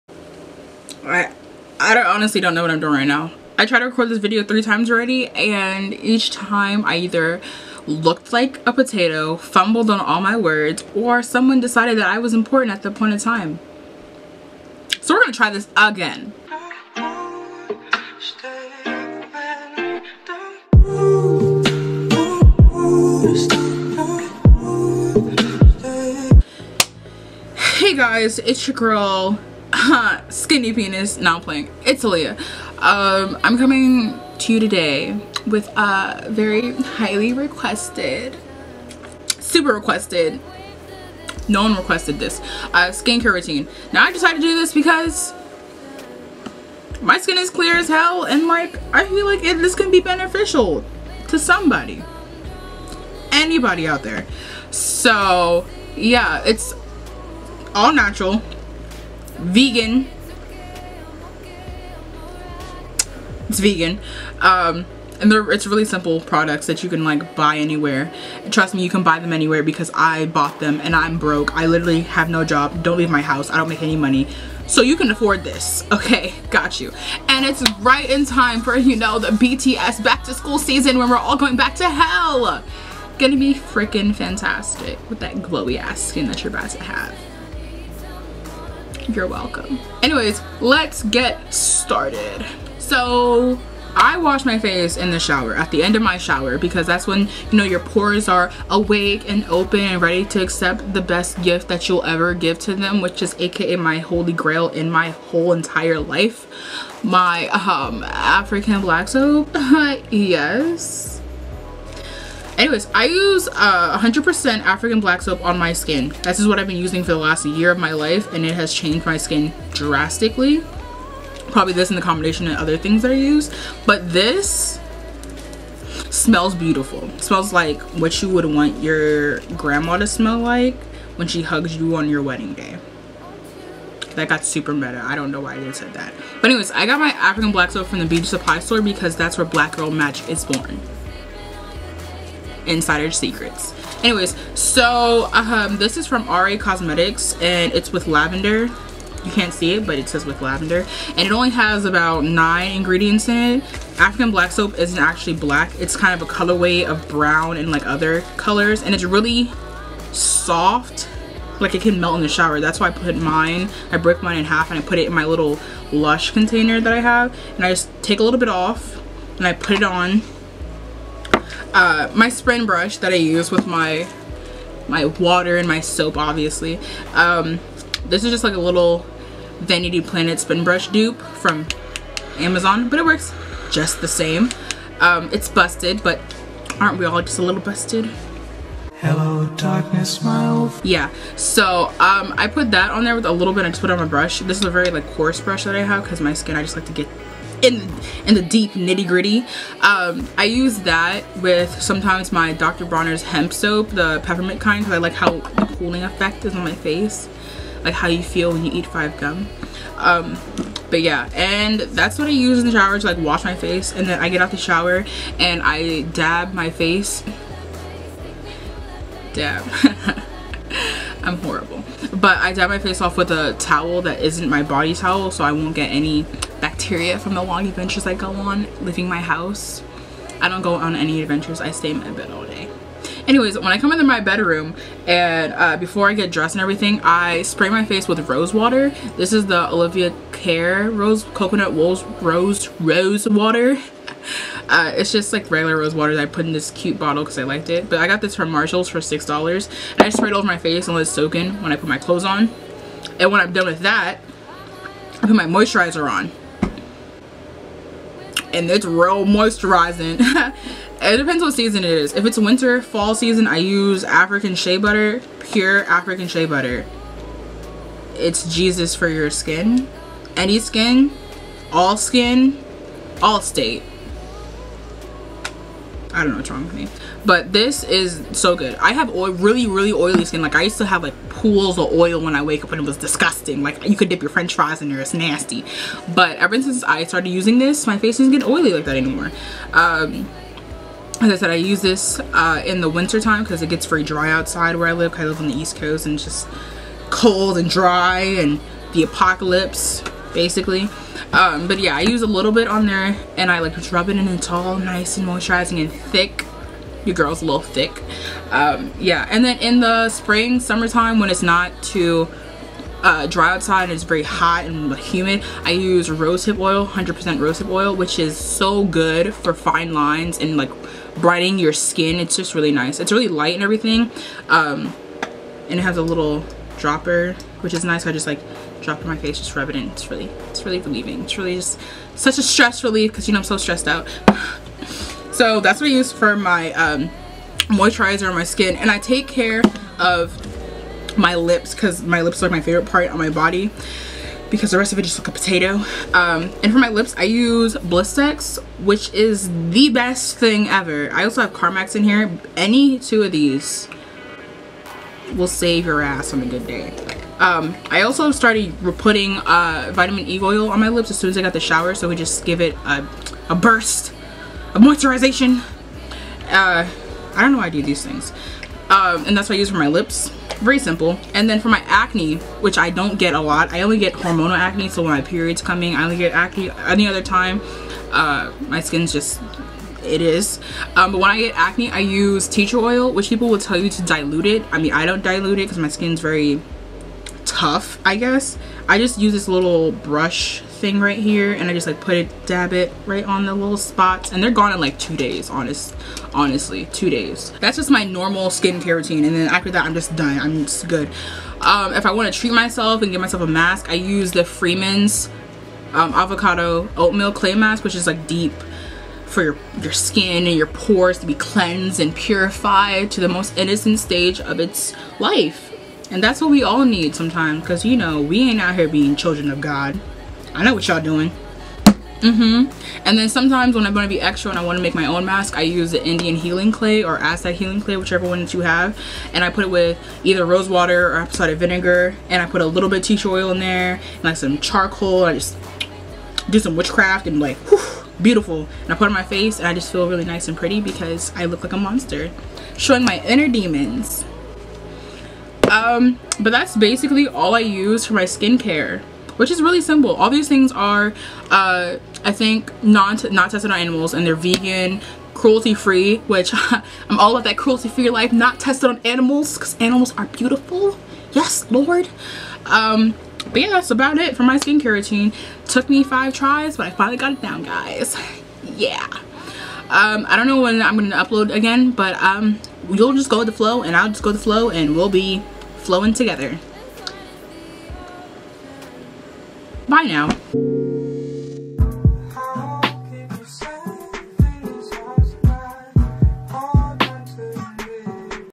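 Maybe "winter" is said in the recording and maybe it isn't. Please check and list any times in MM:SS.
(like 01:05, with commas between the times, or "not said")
04:22, 04:52.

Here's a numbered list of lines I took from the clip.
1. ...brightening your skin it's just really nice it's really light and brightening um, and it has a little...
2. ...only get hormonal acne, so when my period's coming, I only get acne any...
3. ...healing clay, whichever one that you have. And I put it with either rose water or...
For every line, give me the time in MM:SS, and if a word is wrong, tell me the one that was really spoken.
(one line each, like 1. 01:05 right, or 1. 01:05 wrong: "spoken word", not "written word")
1. 05:21 wrong: "everything", not "brightening"
2. 06:13 right
3. 07:07 right.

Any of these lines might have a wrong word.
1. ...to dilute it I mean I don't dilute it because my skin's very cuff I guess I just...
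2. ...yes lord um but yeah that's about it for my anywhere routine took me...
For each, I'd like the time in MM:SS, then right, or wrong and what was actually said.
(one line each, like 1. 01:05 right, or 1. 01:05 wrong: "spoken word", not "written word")
1. 06:23 right
2. 07:41 wrong: "skincare", not "anywhere".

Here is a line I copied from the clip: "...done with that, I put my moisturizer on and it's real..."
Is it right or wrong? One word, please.
right.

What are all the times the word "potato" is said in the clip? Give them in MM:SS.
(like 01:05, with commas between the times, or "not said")
00:08, 05:45.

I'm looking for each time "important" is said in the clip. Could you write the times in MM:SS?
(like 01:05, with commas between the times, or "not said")
00:12.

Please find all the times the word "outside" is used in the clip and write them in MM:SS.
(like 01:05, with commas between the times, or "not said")
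04:54, 05:13.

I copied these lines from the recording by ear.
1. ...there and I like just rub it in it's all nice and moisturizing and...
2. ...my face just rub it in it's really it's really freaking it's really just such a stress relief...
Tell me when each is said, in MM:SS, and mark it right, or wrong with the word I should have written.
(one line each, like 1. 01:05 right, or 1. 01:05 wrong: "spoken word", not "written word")
1. 05:02 right
2. 05:29 wrong: "relieving", not "freaking".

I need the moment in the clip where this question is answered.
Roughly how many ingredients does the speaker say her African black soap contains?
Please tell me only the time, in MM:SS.
02:32.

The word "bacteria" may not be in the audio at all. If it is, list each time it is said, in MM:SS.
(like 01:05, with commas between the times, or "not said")
03:46.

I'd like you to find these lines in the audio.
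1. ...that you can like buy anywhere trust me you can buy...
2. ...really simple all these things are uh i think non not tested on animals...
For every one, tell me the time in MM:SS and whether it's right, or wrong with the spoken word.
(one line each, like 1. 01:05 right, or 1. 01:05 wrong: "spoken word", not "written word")
1. 01:06 right
2. 07:29 right.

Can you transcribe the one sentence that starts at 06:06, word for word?
Uh, I don't know why I do these things.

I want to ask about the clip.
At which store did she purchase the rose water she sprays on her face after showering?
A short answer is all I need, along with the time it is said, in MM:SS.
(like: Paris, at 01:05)
Marshalls, at 04:08.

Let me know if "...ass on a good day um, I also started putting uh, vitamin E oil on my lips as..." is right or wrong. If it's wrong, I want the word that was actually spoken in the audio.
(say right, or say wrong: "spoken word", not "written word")
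right.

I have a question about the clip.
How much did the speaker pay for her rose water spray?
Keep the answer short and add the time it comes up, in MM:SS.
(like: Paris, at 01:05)
$6, at 04:08.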